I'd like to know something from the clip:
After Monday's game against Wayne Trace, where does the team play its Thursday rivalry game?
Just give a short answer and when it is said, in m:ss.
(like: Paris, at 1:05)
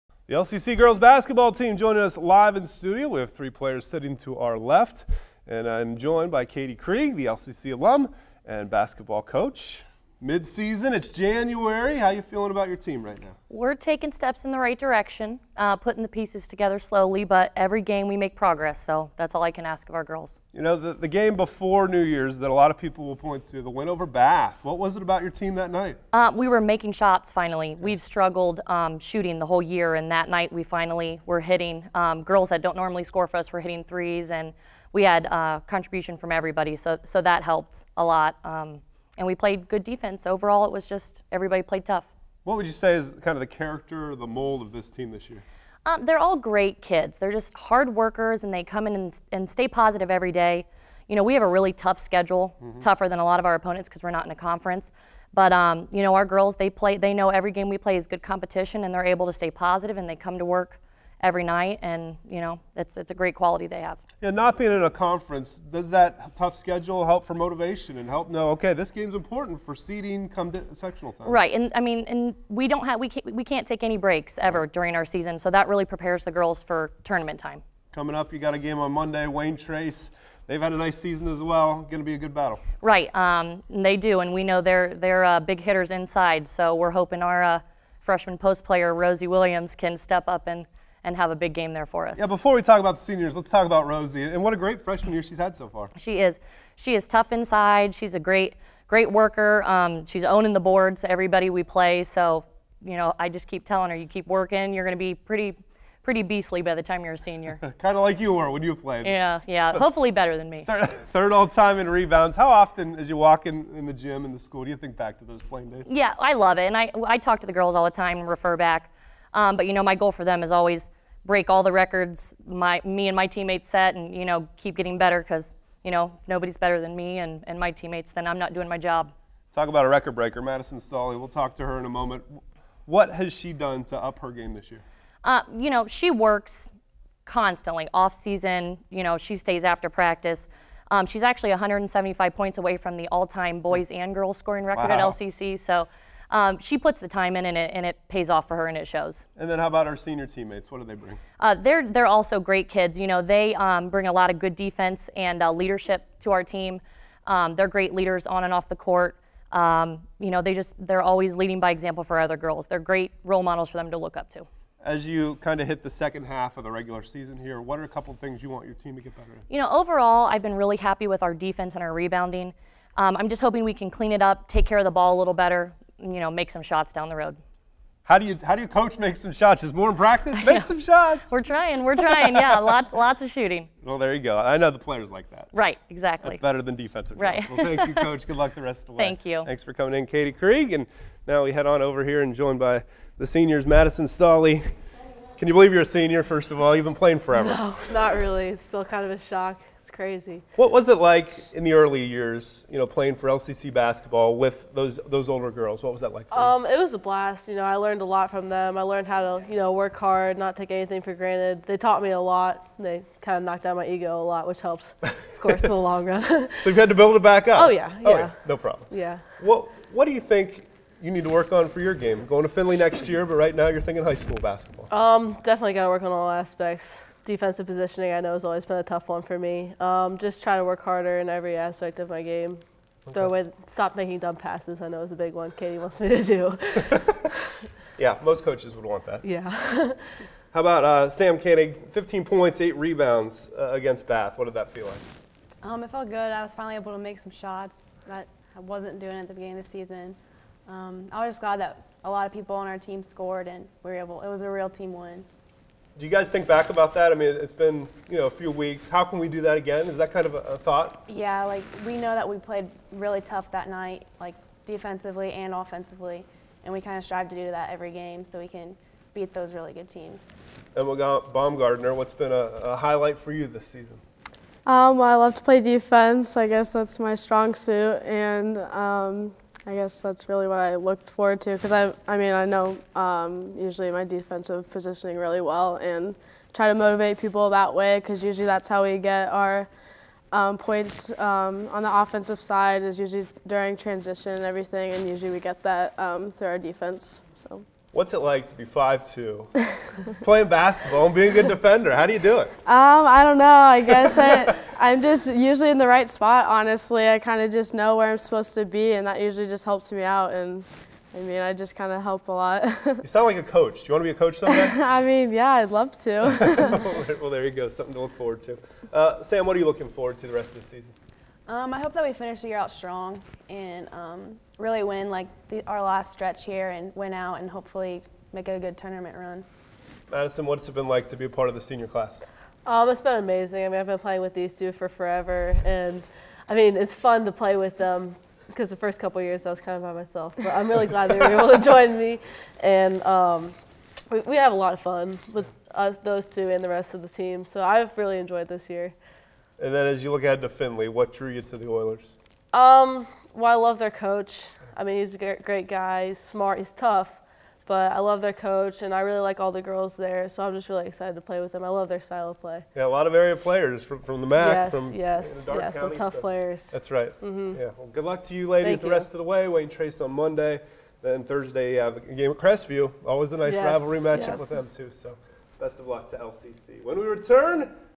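Crestview, at 6:12.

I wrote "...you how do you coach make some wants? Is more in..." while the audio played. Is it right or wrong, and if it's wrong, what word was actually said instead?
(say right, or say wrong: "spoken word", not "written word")
wrong: "shots", not "wants".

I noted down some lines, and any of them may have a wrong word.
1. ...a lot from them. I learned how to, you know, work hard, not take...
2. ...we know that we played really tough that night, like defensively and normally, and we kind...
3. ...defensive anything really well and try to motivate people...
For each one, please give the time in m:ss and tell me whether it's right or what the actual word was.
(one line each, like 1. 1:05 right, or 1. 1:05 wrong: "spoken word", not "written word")
1. 3:28 right
2. 4:21 wrong: "offensively", not "normally"
3. 4:44 wrong: "positioning", not "anything".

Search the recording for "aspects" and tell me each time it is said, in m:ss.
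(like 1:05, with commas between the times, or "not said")
3:46, 3:51.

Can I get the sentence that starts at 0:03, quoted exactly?
We have three players sitting to our left, and I'm joined by Katie Krieg, the LCC alum and basketball coach.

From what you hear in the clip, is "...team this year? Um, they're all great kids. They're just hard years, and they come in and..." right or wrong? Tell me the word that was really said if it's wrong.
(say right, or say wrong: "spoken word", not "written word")
wrong: "workers", not "years".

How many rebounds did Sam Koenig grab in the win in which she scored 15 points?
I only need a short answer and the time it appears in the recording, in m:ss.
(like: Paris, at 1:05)
8, at 4:02.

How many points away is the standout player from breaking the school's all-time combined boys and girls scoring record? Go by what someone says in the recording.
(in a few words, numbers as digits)
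175.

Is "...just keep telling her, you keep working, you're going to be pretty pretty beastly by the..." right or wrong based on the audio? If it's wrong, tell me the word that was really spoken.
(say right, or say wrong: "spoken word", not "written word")
right.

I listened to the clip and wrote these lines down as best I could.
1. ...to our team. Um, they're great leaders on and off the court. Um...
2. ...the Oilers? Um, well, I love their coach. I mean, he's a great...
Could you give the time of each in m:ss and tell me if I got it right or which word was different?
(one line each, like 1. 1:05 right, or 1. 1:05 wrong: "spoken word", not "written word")
1. 2:36 right
2. 5:51 right.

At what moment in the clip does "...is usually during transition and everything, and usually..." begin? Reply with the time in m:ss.
4:52.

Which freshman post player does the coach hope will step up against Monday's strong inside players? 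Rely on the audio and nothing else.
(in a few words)
Rosie Williams.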